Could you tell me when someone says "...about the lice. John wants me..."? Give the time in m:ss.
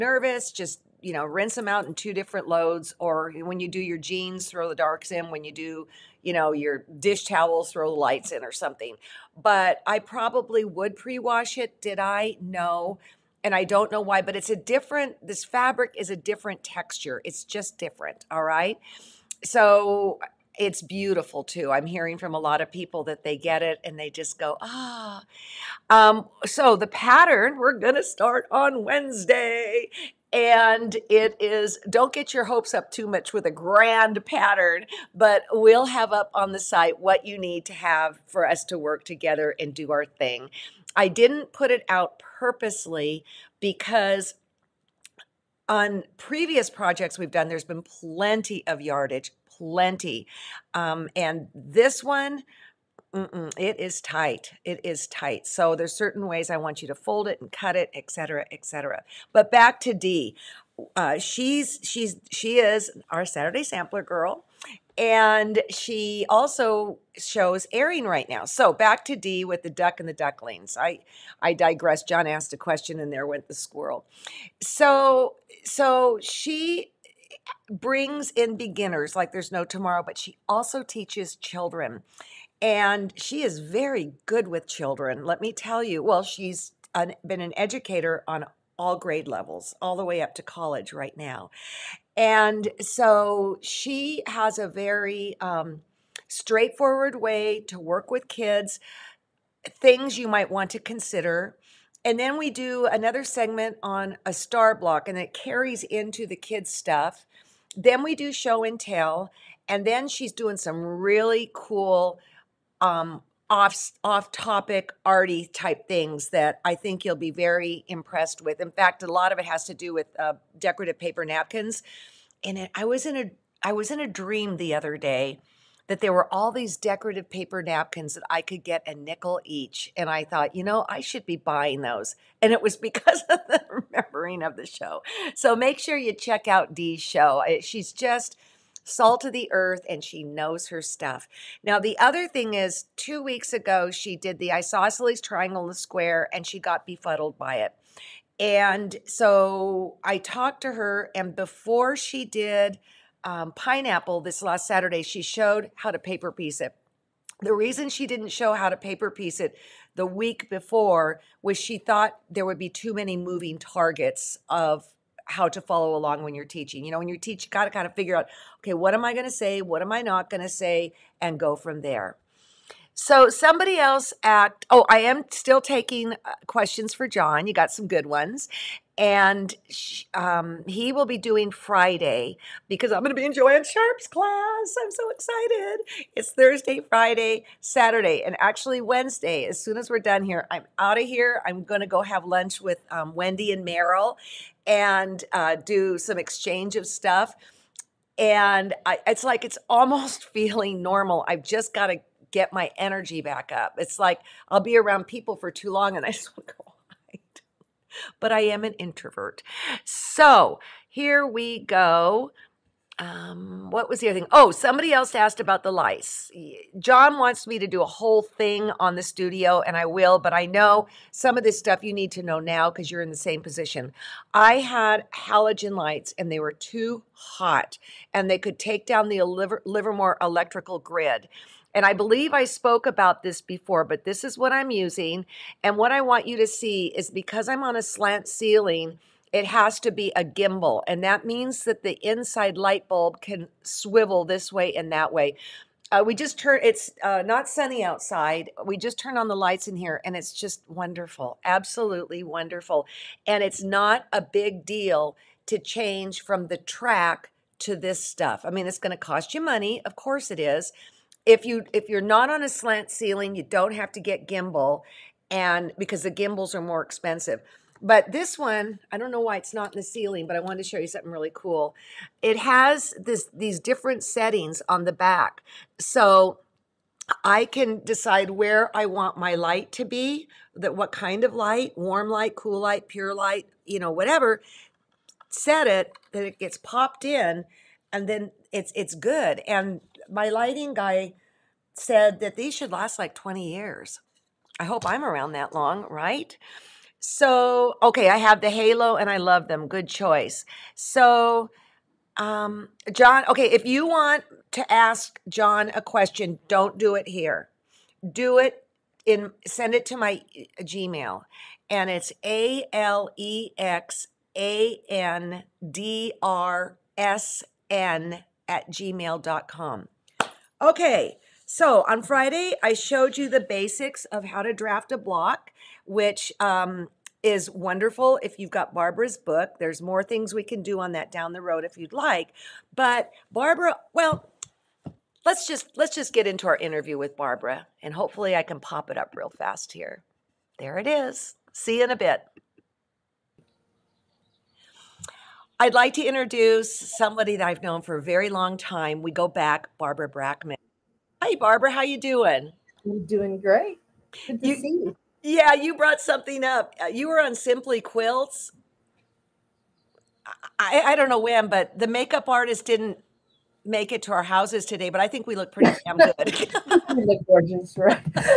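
3:35.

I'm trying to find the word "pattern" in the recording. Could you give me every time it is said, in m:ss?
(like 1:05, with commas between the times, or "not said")
0:26, 0:34.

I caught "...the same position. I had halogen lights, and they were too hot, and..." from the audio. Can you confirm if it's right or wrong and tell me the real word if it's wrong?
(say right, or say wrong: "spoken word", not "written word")
right.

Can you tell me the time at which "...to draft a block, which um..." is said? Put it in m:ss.
5:24.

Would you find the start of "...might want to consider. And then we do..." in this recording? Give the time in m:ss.
1:40.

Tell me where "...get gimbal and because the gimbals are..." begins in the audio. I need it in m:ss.
4:24.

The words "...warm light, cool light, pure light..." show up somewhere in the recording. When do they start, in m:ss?
4:41.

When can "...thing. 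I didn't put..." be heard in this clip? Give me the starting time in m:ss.
0:40.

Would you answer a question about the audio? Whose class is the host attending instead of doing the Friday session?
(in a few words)
Joanne Sharp.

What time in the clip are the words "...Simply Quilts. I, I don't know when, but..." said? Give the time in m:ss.
5:57.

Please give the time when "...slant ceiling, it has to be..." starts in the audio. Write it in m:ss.
3:57.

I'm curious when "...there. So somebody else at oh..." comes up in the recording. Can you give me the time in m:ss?
2:51.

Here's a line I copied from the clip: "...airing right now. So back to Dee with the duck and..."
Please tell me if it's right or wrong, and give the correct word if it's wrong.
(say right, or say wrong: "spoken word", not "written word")
right.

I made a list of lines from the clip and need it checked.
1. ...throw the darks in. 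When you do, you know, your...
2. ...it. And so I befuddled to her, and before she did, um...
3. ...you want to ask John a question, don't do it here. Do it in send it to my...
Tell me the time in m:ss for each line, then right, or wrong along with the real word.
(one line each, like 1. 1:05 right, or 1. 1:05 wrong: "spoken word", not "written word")
1. 0:04 right
2. 2:27 wrong: "talked", not "befuddled"
3. 5:03 right.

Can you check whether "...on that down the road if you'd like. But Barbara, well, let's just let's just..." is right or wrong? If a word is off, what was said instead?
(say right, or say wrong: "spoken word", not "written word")
right.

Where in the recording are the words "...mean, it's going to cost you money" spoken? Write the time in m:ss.
4:18.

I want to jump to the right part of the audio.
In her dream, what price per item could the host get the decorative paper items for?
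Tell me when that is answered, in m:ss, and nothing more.
2:08.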